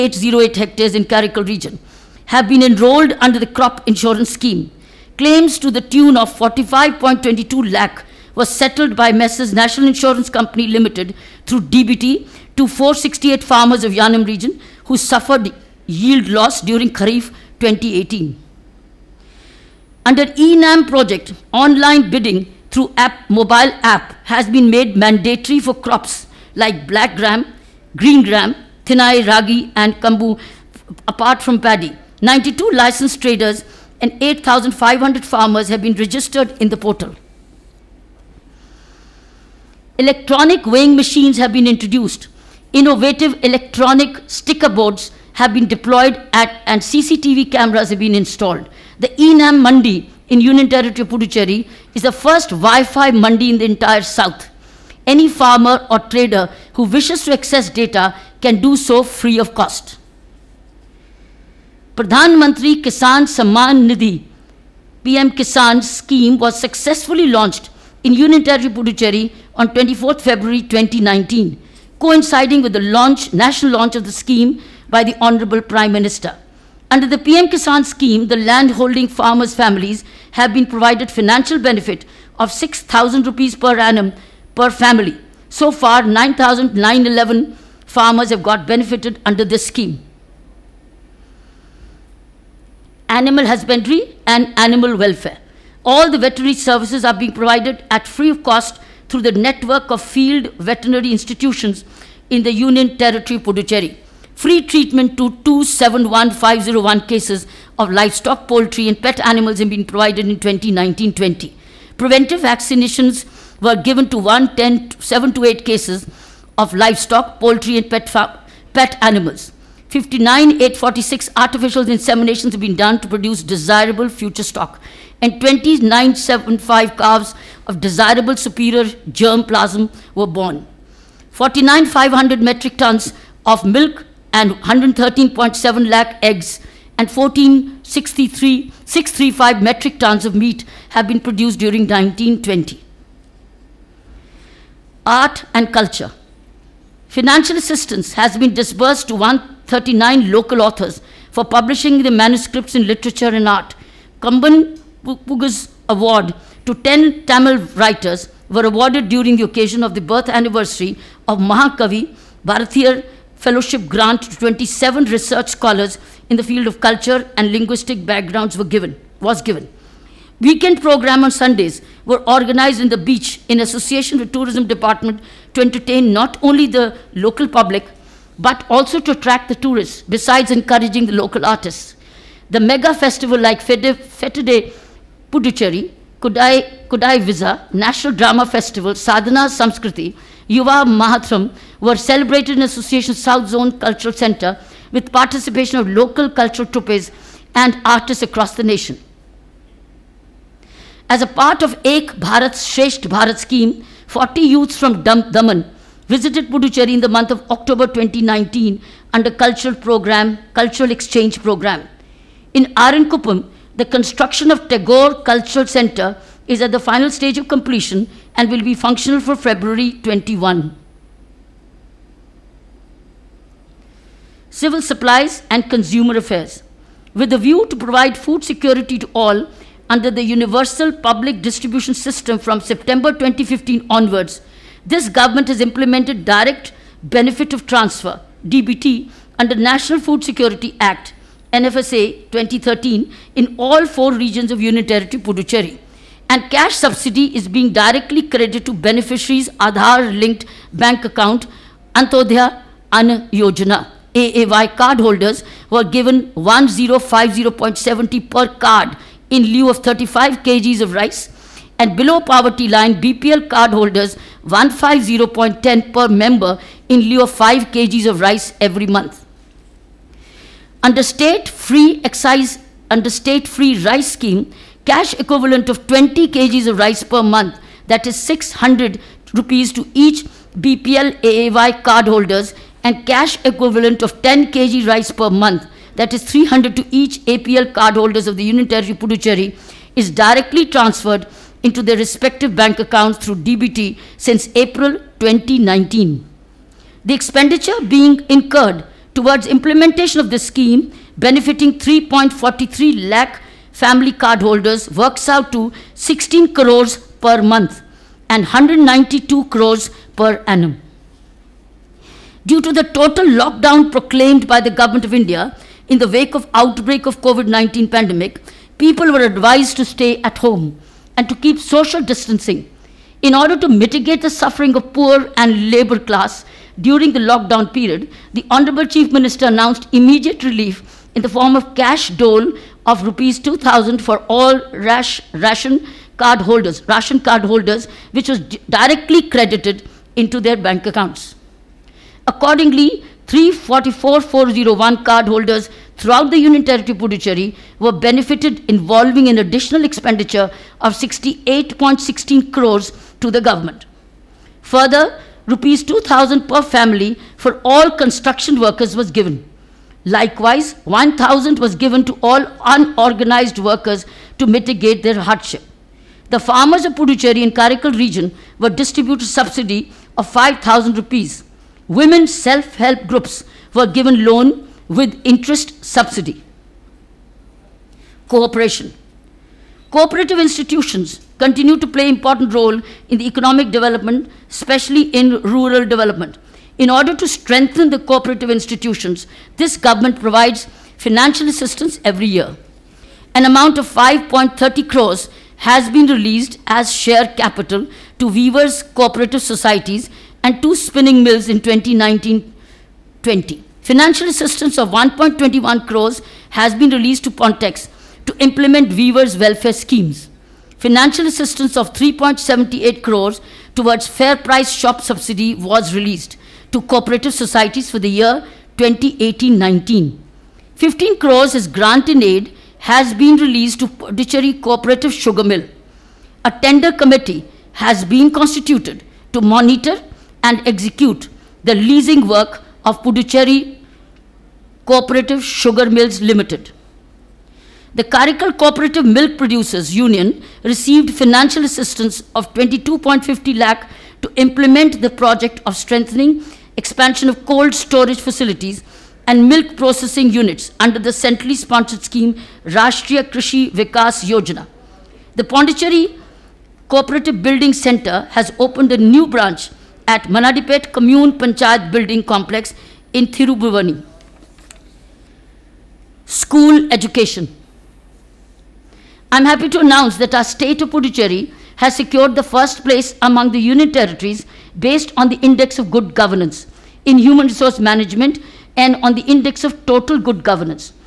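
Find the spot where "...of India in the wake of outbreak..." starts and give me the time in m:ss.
5:15.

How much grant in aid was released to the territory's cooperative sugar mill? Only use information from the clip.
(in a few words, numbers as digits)
15 crores.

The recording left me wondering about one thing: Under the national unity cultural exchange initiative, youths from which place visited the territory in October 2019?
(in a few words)
Daman.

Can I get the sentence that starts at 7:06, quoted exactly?
A tender committee has been constituted to monitor and execute the leasing work of Puducherry Cooperative Sugar Mills Limited.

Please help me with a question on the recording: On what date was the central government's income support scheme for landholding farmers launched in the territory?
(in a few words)
24th February 2019.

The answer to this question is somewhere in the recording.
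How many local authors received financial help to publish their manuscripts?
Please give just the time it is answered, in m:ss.
2:29.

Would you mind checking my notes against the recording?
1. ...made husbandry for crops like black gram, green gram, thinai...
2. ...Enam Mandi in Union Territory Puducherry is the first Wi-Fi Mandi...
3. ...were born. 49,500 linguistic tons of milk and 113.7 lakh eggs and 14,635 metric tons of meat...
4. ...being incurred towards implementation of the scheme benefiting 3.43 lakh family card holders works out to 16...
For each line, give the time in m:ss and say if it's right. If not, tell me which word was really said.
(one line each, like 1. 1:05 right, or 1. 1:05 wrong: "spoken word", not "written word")
1. 0:24 wrong: "mandatory", not "husbandry"
2. 0:49 right
3. 2:10 wrong: "metric", not "linguistic"
4. 4:57 right.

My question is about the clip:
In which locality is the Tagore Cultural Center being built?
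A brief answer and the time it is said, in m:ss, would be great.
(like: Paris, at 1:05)
Arankuppam, at 3:32.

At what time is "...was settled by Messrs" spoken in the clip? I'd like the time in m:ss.
0:08.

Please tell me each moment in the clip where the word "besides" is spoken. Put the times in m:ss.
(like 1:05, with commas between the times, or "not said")
3:00.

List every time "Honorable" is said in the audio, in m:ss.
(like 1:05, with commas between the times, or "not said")
1:15, 5:28.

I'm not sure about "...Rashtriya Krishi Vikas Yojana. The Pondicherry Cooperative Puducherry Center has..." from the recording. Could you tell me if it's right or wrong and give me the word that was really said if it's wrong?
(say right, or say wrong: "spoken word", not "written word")
wrong: "Building", not "Puducherry".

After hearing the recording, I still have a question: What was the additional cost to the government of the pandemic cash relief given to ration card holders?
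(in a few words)
68.16 crores.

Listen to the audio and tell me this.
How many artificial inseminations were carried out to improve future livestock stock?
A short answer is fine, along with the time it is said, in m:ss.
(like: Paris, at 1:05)
59,846, at 1:59.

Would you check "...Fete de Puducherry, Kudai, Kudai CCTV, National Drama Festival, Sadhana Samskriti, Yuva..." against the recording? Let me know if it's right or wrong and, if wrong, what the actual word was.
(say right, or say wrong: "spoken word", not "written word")
wrong: "Visa", not "CCTV".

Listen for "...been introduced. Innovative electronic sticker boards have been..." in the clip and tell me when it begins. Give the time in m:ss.
0:41.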